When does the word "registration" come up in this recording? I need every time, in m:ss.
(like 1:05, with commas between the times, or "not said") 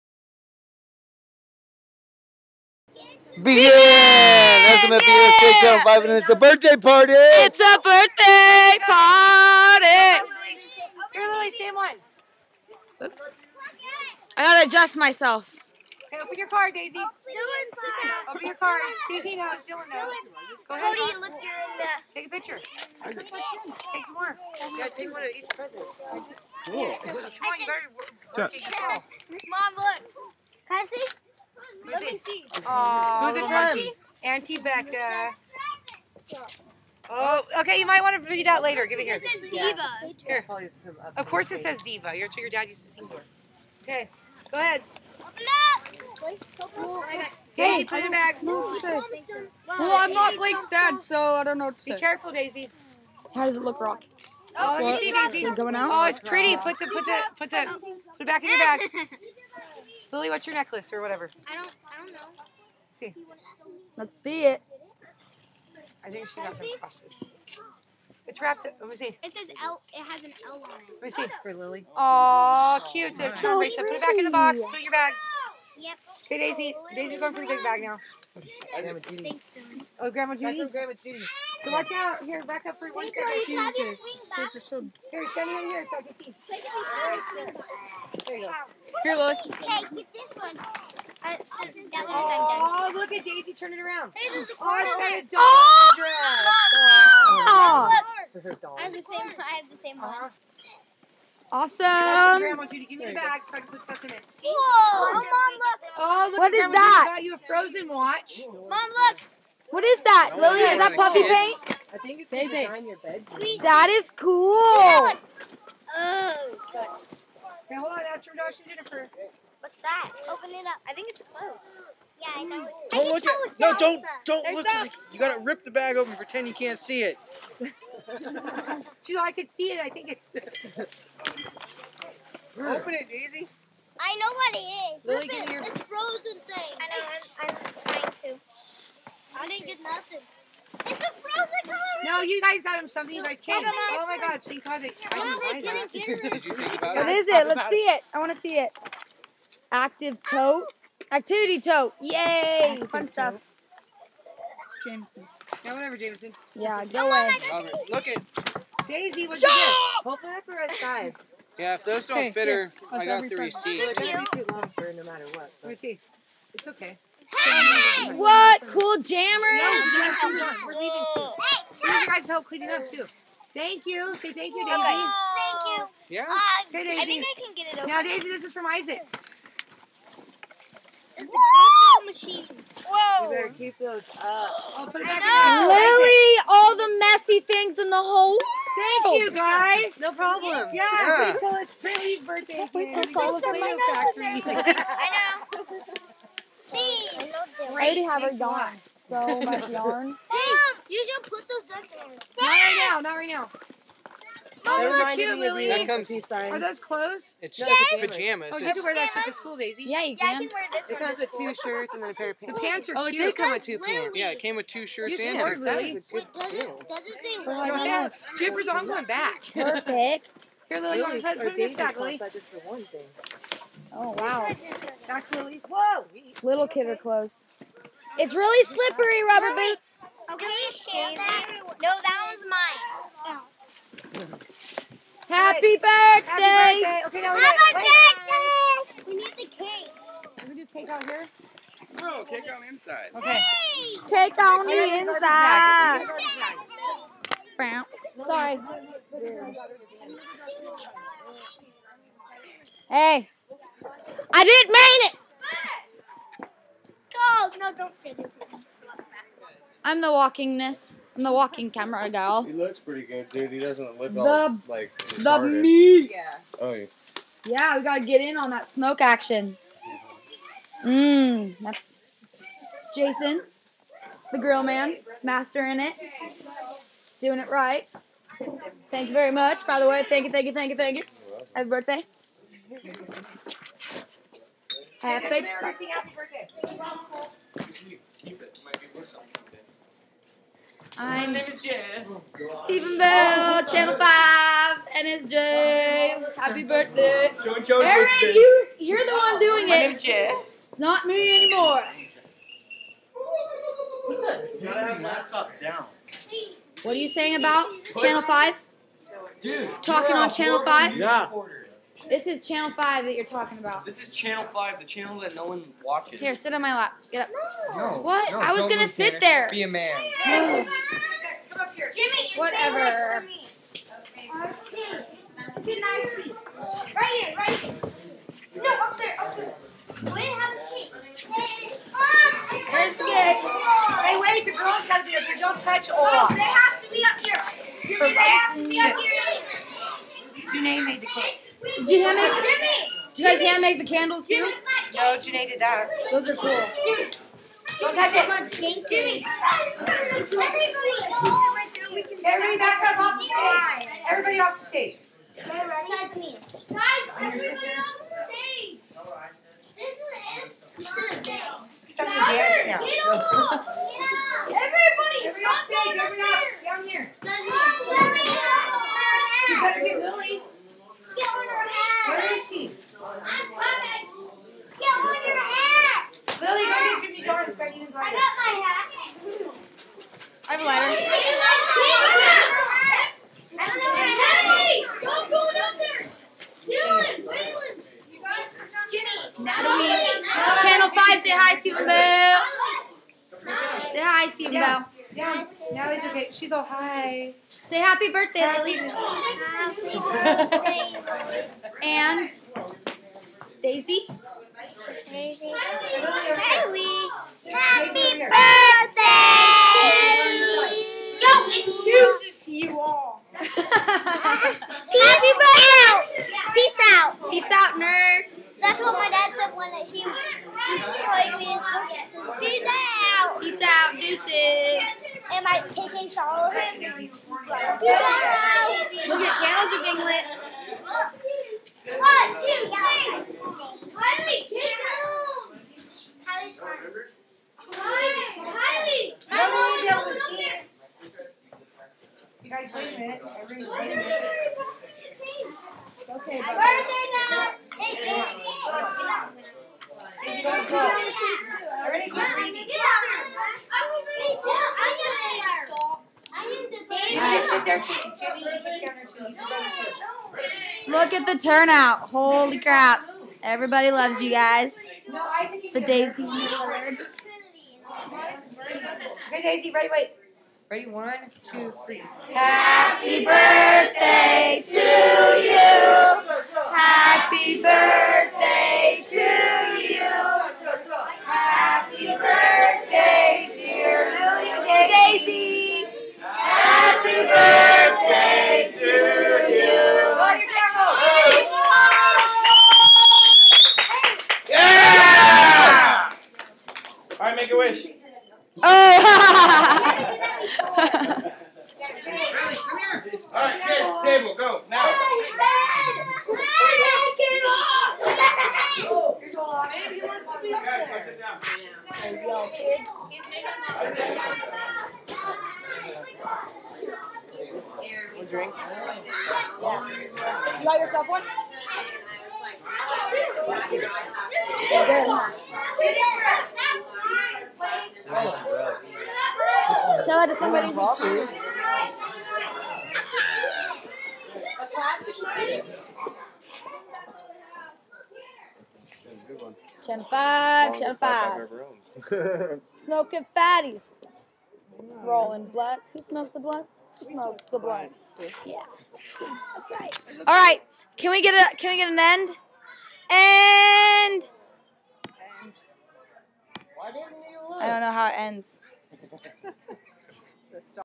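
not said.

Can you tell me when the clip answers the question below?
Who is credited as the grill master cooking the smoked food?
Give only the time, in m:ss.
4:32.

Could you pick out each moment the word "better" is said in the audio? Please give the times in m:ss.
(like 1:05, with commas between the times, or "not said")
0:27, 3:03, 6:09.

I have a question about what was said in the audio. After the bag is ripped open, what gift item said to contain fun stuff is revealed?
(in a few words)
Activity tote.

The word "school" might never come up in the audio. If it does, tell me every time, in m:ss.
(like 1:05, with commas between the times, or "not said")
3:29.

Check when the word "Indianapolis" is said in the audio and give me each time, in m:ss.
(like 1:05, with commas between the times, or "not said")
not said.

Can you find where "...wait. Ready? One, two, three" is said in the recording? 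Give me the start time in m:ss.
7:49.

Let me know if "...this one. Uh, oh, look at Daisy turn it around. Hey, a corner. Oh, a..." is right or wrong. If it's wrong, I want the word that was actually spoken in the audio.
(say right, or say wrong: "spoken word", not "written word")
right.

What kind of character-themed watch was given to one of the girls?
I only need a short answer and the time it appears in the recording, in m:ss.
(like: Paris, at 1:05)
Frozen watch, at 1:47.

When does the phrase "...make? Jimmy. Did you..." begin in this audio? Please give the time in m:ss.
5:42.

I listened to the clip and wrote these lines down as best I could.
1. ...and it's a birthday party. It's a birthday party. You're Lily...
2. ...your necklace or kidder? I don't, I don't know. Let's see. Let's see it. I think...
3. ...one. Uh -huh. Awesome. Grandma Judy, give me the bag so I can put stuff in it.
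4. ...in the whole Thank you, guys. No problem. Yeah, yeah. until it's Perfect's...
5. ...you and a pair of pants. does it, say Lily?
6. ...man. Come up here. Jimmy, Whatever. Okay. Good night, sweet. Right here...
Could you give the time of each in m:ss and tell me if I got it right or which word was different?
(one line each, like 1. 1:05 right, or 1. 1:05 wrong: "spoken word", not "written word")
1. 0:06 right
2. 1:00 wrong: "whatever", not "kidder"
3. 1:39 right
4. 3:07 wrong: "Brandy", not "Perfect"
5. 3:35 right
6. 5:19 right.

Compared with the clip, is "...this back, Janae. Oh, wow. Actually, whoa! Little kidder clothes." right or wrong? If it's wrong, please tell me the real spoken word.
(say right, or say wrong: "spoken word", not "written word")
wrong: "Lily", not "Janae".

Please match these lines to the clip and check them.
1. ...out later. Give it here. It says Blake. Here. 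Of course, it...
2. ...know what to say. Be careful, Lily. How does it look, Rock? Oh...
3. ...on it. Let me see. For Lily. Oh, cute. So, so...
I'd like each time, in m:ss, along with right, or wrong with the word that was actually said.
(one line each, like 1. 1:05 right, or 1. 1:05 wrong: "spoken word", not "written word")
1. 0:38 wrong: "Diva", not "Blake"
2. 0:51 wrong: "Daisy", not "Lily"
3. 1:10 right.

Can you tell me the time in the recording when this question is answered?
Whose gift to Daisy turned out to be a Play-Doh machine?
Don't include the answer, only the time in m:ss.
2:58.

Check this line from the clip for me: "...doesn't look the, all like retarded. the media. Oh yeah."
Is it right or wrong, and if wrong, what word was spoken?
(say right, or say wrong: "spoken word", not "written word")
right.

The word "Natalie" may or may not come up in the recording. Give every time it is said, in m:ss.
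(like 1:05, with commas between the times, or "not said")
6:29.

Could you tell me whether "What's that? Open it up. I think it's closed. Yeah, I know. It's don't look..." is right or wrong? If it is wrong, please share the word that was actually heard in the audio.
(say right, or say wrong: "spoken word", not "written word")
right.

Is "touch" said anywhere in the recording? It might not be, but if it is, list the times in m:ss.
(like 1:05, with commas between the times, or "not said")
5:35, 5:47.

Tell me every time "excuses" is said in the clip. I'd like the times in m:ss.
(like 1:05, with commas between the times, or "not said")
6:51.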